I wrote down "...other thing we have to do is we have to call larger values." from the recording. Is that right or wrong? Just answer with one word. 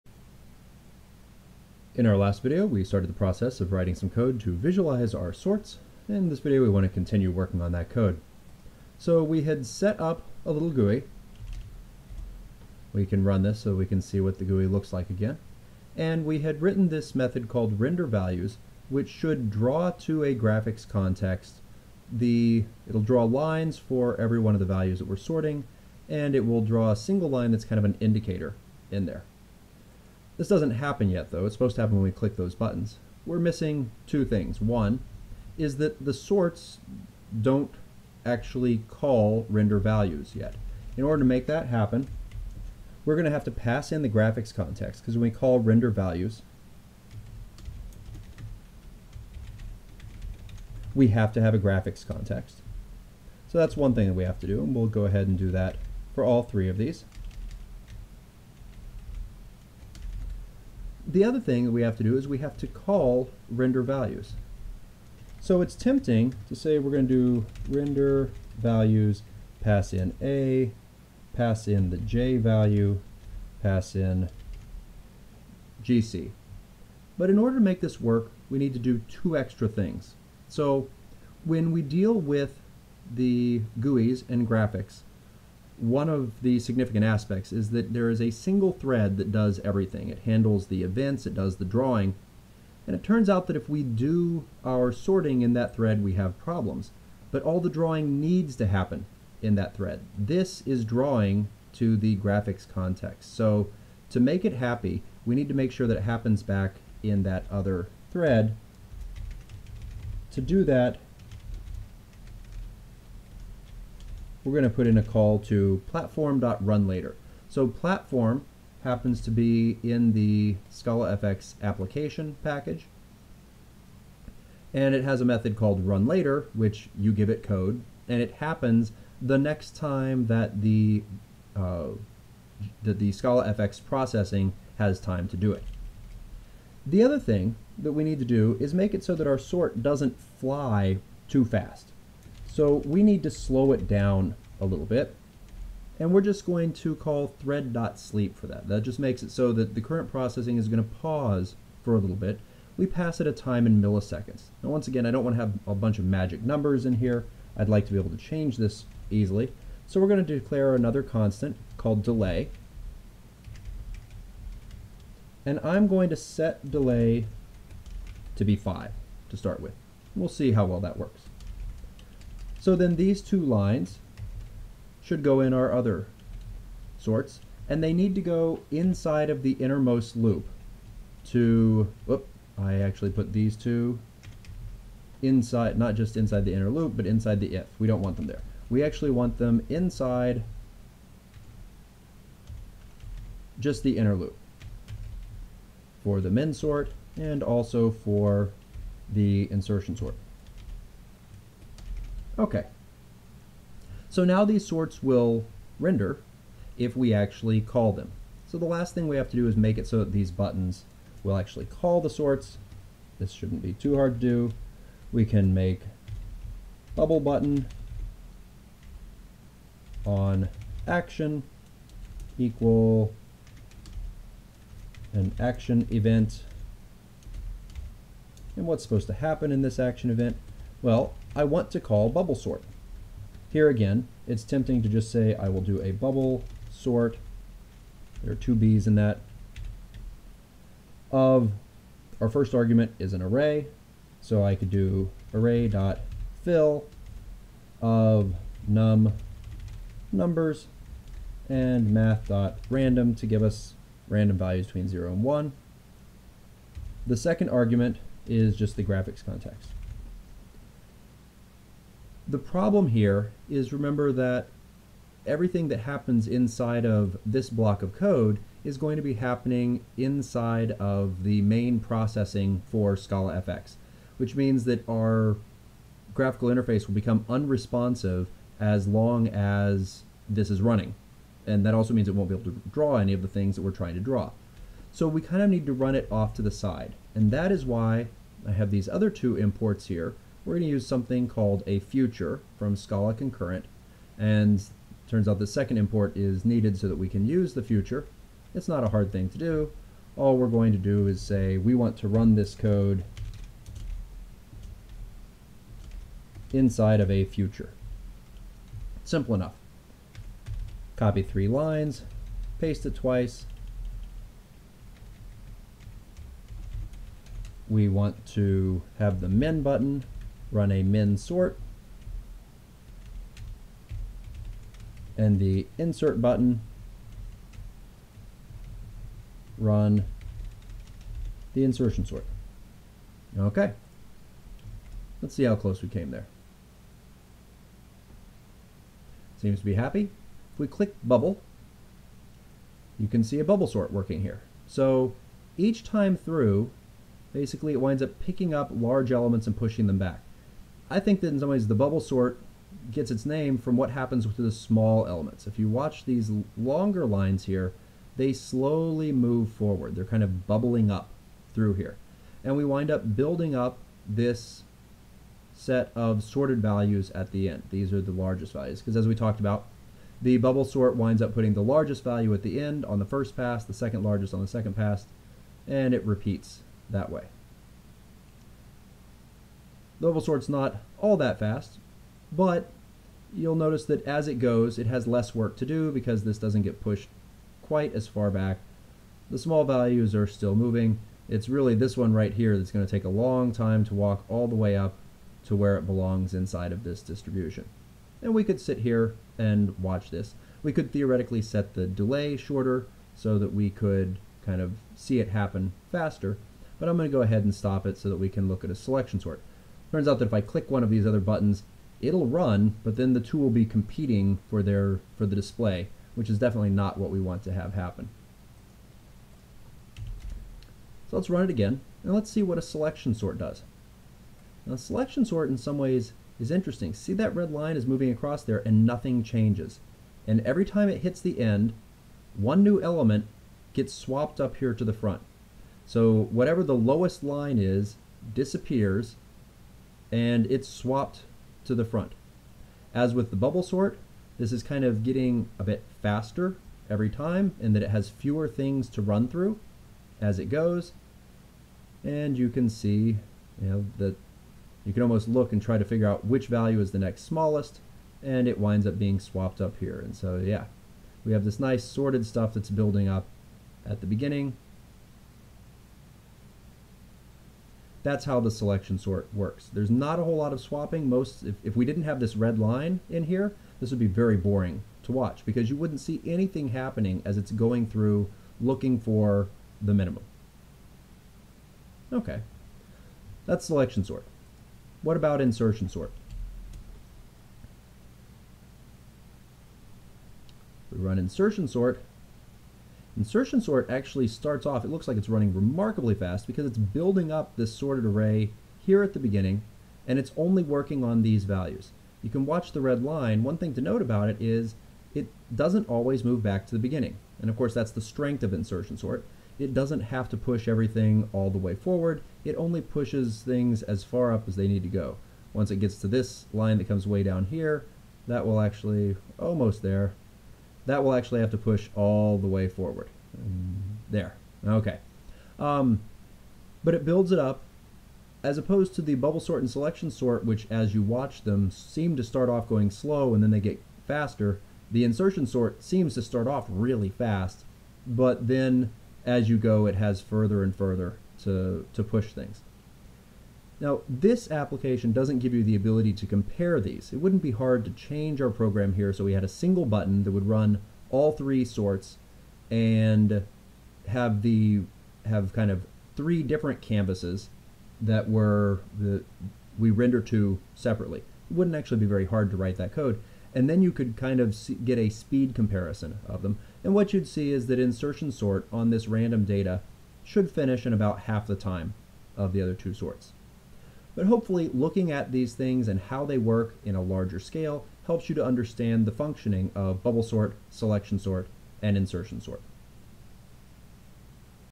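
wrong.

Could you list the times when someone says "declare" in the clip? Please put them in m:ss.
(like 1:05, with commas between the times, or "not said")
2:40.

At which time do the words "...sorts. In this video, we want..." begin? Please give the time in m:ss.
0:05.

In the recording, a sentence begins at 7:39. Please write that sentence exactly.
And so, yeah, we have this nice sorted stuff that's building up at the beginning That's how the selection sort works.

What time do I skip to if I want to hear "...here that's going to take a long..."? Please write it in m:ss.
6:32.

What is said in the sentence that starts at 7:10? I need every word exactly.
And every time it hits the end, one new element gets swapped up here to the front.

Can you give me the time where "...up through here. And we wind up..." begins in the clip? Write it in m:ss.
6:00.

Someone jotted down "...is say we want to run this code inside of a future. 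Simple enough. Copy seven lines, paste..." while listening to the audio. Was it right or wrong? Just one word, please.
wrong.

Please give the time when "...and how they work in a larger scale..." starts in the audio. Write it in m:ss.
9:35.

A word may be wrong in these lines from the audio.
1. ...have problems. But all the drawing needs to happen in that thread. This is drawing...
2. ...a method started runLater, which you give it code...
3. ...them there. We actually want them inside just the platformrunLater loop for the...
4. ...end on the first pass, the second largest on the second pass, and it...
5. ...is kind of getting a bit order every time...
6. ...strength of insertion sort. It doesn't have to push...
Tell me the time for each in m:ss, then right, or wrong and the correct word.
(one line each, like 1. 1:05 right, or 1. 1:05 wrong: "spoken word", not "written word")
1. 1:36 right
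2. 2:05 wrong: "called", not "started"
3. 3:08 wrong: "inner", not "platformrunLater"
4. 6:12 right
5. 7:24 wrong: "faster", not "order"
6. 8:28 right.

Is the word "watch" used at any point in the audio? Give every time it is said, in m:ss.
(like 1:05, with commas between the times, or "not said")
5:55, 6:39, 7:55, 8:22, 8:51.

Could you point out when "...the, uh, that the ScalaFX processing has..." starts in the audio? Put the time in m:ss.
2:10.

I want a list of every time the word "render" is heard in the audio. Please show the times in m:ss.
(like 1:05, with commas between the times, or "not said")
0:17, 0:39, 0:45, 1:03, 1:07, 3:25, 9:19.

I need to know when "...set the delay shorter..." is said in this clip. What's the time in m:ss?
6:41.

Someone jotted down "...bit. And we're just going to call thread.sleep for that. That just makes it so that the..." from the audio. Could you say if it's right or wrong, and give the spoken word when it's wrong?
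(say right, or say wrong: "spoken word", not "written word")
right.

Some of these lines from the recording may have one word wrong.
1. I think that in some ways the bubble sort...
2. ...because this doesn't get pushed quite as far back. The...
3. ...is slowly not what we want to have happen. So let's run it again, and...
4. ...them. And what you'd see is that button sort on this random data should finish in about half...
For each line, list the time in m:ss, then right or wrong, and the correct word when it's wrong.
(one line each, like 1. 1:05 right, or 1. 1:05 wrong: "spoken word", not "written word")
1. 5:50 right
2. 6:25 right
3. 6:56 wrong: "definitely", not "slowly"
4. 9:26 wrong: "insertion", not "button".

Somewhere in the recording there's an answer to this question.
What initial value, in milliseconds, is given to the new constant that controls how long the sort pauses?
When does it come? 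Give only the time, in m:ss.
2:48.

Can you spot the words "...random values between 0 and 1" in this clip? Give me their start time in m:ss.
4:14.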